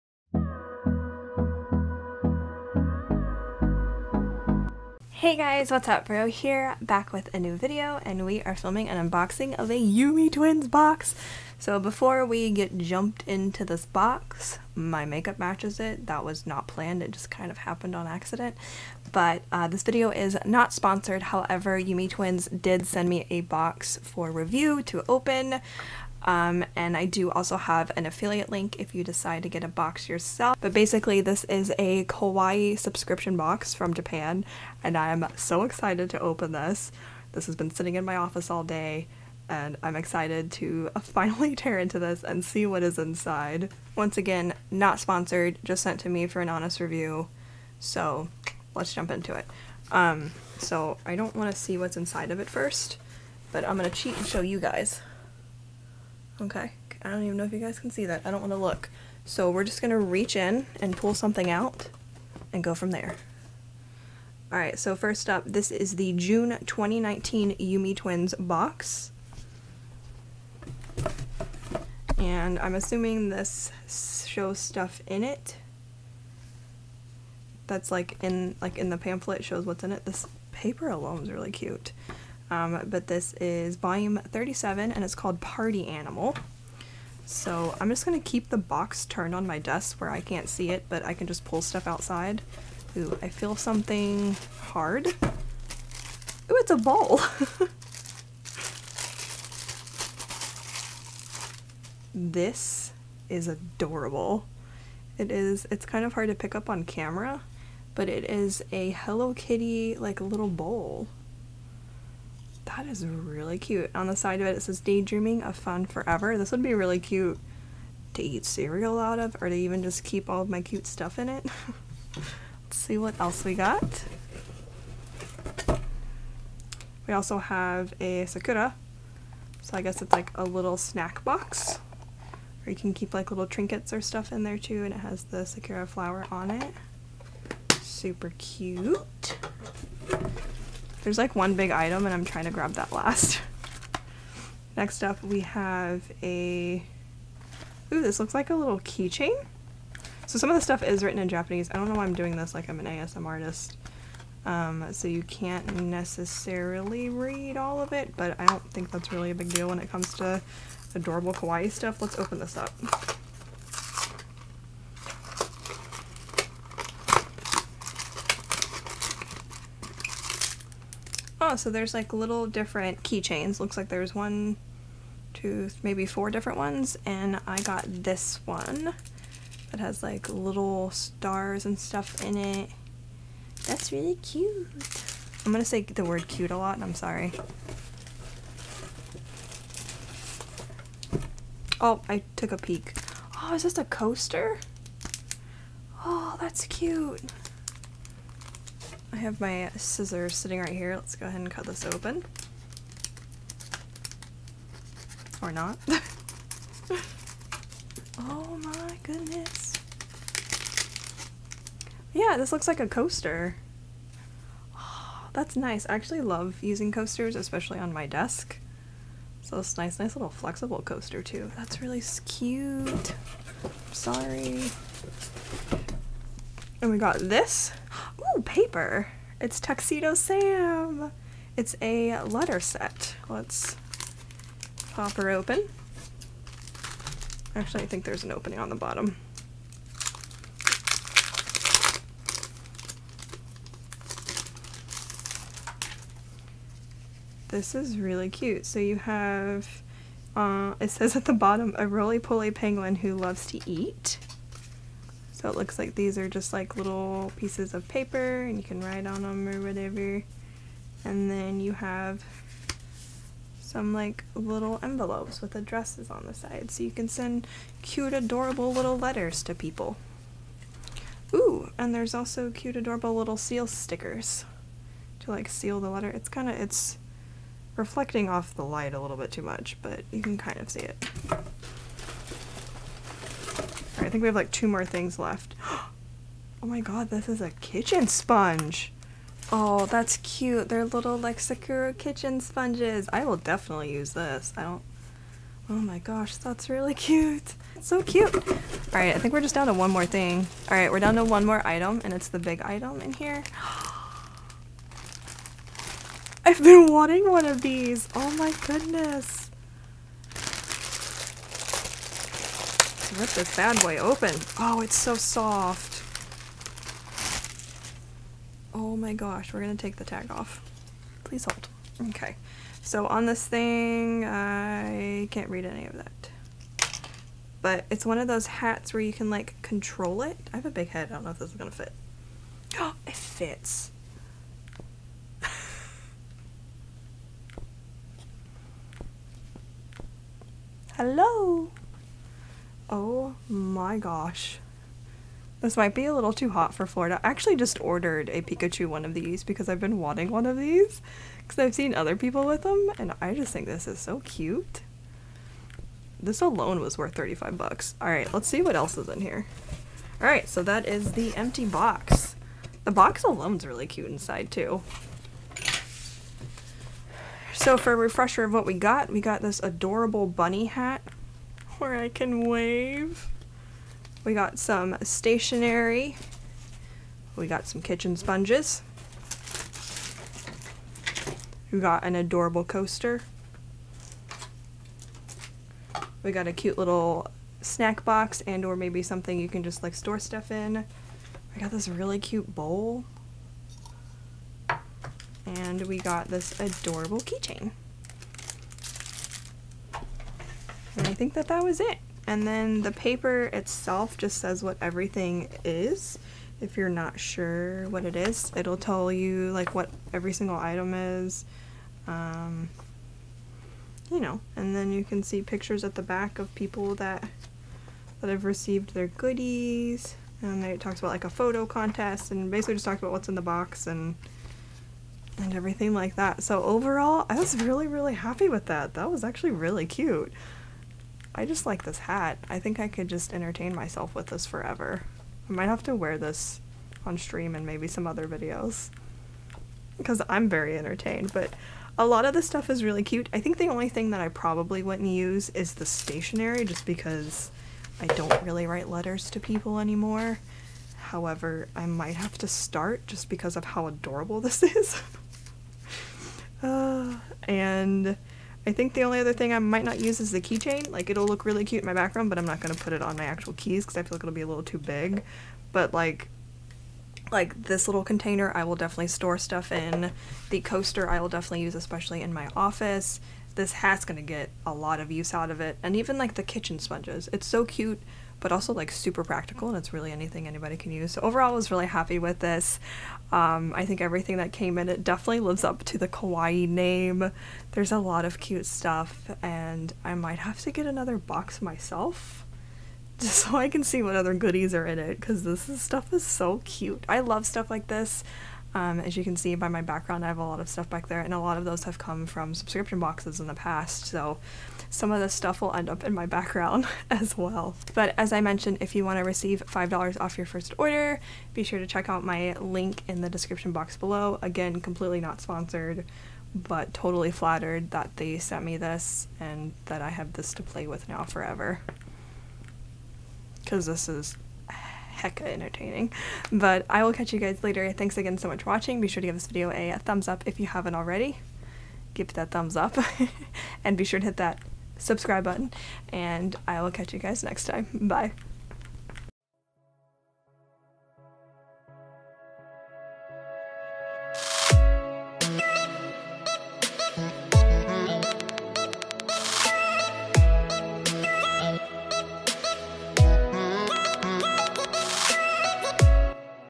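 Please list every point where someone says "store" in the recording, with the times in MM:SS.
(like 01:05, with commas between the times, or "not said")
06:29, 07:49.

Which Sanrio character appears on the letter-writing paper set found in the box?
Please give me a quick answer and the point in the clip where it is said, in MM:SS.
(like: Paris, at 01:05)
Tuxedo Sam, at 03:49.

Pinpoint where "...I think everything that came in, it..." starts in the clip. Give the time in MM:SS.
08:03.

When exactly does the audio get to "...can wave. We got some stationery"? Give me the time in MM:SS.
06:12.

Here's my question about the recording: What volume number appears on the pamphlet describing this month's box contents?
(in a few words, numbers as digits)
37.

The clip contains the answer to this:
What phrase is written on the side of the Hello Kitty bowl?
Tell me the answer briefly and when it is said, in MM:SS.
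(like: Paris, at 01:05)
Daydreaming of Fun Forever, at 01:54.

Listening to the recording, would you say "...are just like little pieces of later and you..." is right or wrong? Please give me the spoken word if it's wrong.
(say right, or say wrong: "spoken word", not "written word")
wrong: "paper", not "later".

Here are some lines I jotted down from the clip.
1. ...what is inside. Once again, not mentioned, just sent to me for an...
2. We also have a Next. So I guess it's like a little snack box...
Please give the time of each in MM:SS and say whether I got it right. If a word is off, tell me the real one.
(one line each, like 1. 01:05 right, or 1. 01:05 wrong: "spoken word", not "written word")
1. 00:42 wrong: "sponsored", not "mentioned"
2. 02:07 wrong: "Sakura", not "Next".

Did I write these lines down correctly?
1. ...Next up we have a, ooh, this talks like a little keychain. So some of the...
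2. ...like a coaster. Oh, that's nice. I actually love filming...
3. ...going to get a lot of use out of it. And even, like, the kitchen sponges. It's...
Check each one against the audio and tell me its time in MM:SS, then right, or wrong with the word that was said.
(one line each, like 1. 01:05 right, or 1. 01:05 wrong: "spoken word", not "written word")
1. 02:24 wrong: "looks", not "talks"
2. 03:32 wrong: "using", not "filming"
3. 07:54 right.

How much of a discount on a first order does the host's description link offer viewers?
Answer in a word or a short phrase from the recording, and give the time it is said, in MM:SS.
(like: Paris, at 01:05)
$5, at 08:29.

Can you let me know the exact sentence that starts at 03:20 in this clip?
Let's go ahead and cut this open.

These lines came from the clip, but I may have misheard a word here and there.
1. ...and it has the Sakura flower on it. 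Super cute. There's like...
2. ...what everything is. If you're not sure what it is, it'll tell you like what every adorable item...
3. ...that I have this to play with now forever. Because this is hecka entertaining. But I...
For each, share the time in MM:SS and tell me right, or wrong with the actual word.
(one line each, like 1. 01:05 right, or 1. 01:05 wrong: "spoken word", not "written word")
1. 02:14 right
2. 06:44 wrong: "single", not "adorable"
3. 08:39 right.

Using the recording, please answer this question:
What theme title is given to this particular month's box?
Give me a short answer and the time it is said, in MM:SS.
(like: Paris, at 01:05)
Party Animal, at 01:25.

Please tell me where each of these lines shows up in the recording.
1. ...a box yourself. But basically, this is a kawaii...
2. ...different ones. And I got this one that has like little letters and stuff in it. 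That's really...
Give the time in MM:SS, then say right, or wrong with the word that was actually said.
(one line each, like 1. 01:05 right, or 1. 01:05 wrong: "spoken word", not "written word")
1. 00:29 right
2. 02:56 wrong: "stars", not "letters".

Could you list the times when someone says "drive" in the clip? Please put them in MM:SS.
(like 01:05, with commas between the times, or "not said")
not said.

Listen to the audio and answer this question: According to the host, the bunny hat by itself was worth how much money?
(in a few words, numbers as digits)
$35.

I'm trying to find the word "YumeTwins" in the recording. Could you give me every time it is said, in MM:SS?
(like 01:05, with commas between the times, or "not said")
00:09, 00:21, 01:07.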